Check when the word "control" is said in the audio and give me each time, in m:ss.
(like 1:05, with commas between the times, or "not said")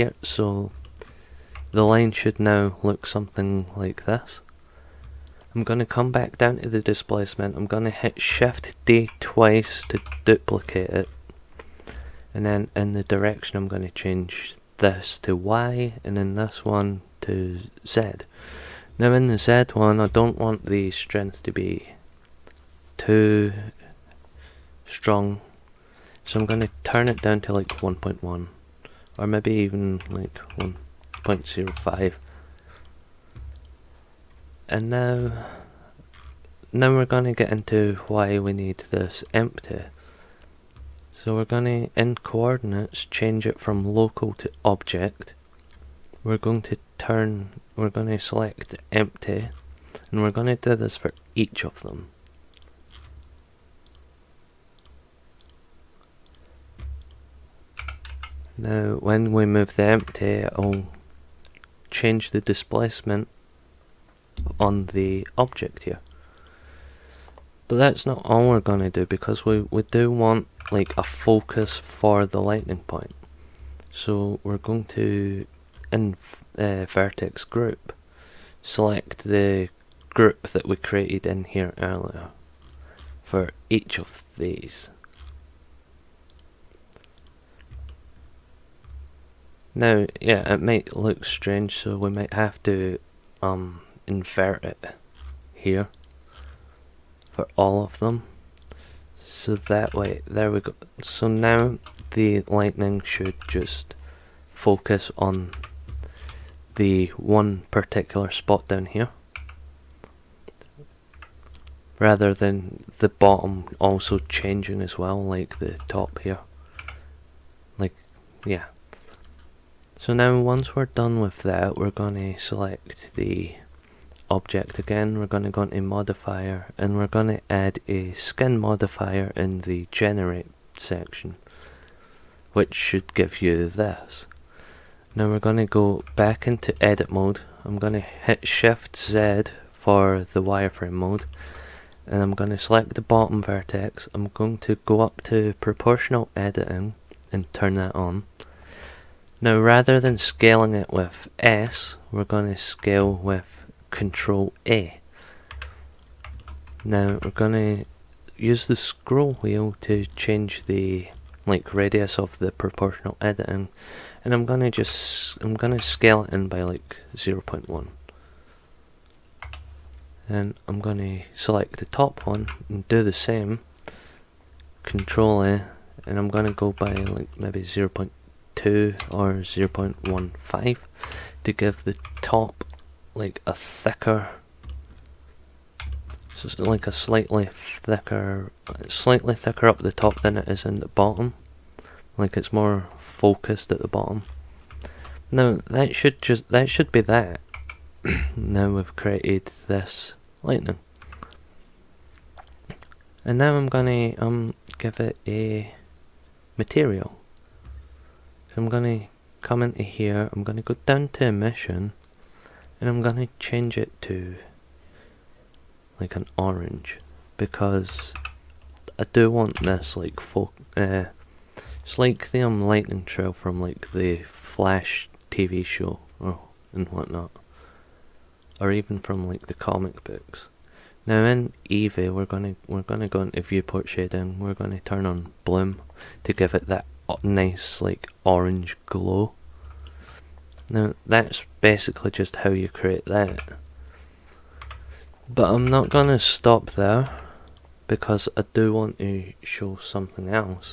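2:33, 2:54.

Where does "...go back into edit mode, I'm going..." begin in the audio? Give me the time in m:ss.
2:15.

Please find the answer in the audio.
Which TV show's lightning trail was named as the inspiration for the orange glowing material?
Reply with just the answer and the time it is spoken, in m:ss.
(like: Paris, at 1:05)
The Flash, at 3:43.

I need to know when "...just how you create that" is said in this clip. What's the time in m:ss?
4:02.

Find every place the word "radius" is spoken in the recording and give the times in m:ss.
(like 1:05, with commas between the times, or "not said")
2:41.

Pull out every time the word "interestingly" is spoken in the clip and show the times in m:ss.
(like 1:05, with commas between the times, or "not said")
not said.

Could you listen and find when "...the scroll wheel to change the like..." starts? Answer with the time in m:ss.
2:38.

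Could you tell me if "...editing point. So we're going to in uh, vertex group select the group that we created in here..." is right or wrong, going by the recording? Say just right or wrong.
wrong.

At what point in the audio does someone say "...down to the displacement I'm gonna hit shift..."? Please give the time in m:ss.
0:06.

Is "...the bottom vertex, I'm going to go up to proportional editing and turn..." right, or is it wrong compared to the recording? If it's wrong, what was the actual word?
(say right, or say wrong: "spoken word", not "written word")
right.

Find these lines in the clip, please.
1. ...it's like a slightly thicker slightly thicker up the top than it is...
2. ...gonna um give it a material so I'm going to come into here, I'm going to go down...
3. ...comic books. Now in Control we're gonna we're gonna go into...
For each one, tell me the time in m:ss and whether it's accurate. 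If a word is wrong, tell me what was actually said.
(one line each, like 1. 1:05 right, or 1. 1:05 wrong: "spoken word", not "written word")
1. 3:06 right
2. 3:23 right
3. 3:49 wrong: "Eevee", not "Control".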